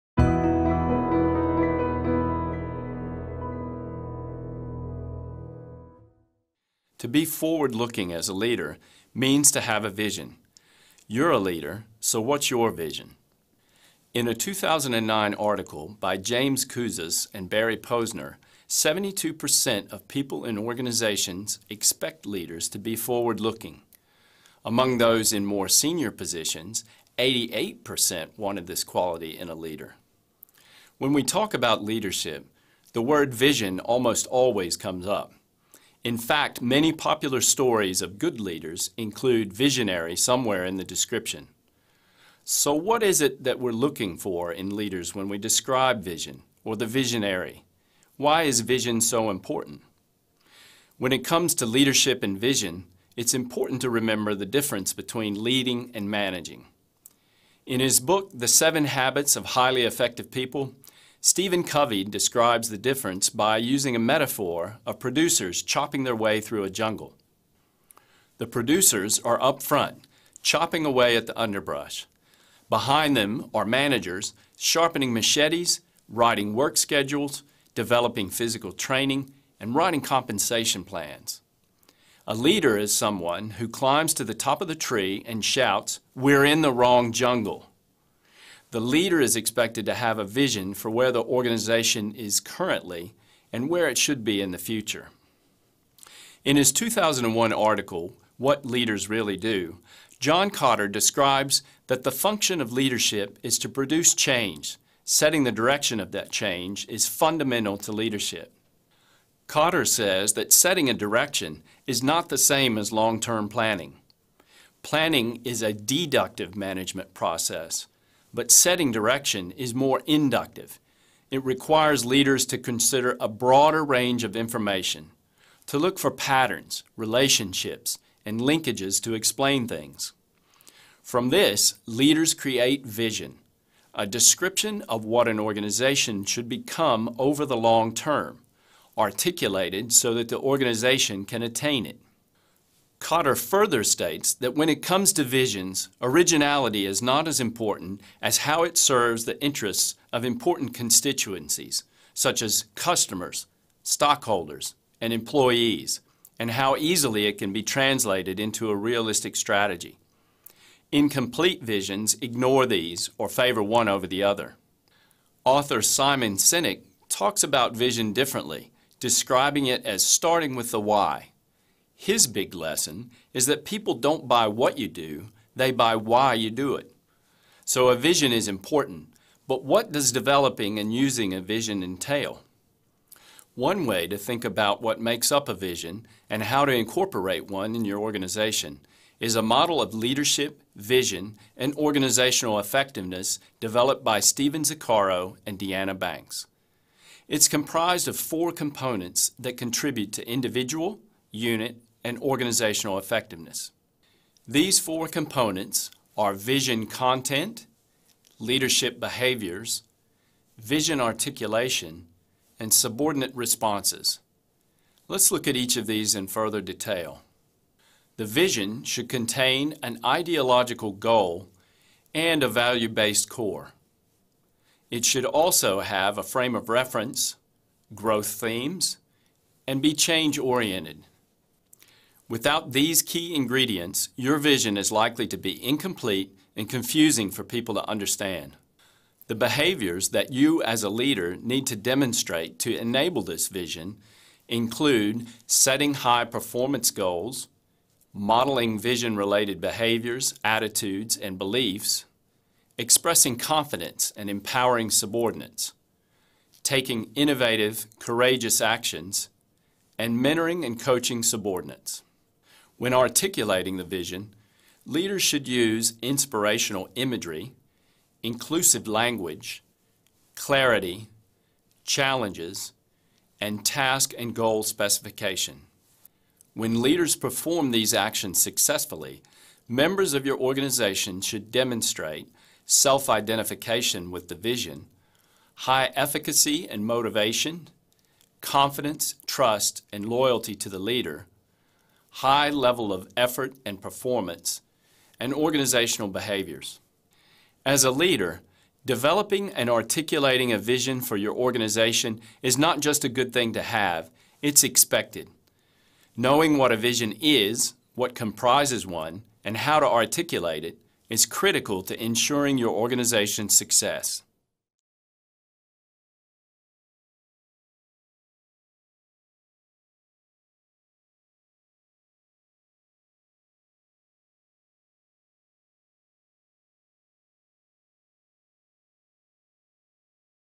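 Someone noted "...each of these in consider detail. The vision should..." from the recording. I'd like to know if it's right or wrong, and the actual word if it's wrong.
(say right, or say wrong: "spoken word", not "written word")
wrong: "further", not "consider".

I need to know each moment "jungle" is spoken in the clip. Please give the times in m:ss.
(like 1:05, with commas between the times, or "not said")
1:06, 1:27.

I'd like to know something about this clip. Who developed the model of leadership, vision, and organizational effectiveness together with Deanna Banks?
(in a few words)
Steven Zaccaro.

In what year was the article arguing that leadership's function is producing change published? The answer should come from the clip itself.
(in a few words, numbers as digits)
2001.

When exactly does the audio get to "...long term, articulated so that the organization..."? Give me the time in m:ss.
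2:17.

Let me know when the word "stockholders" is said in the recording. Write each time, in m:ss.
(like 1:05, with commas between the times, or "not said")
2:33.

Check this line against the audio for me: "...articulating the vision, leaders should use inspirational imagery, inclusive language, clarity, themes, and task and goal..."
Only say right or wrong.
wrong.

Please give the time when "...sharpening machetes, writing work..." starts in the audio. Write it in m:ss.
1:14.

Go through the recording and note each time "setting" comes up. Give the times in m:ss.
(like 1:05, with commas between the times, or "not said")
1:45, 1:50, 1:58, 4:05.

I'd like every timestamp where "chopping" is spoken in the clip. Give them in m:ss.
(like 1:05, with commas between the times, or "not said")
1:05, 1:10.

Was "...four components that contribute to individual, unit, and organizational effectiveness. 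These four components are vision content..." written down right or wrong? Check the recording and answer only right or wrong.
right.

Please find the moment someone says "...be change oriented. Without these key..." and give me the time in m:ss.
3:49.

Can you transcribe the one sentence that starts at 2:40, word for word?
Incomplete visions ignore these or favor one over the other.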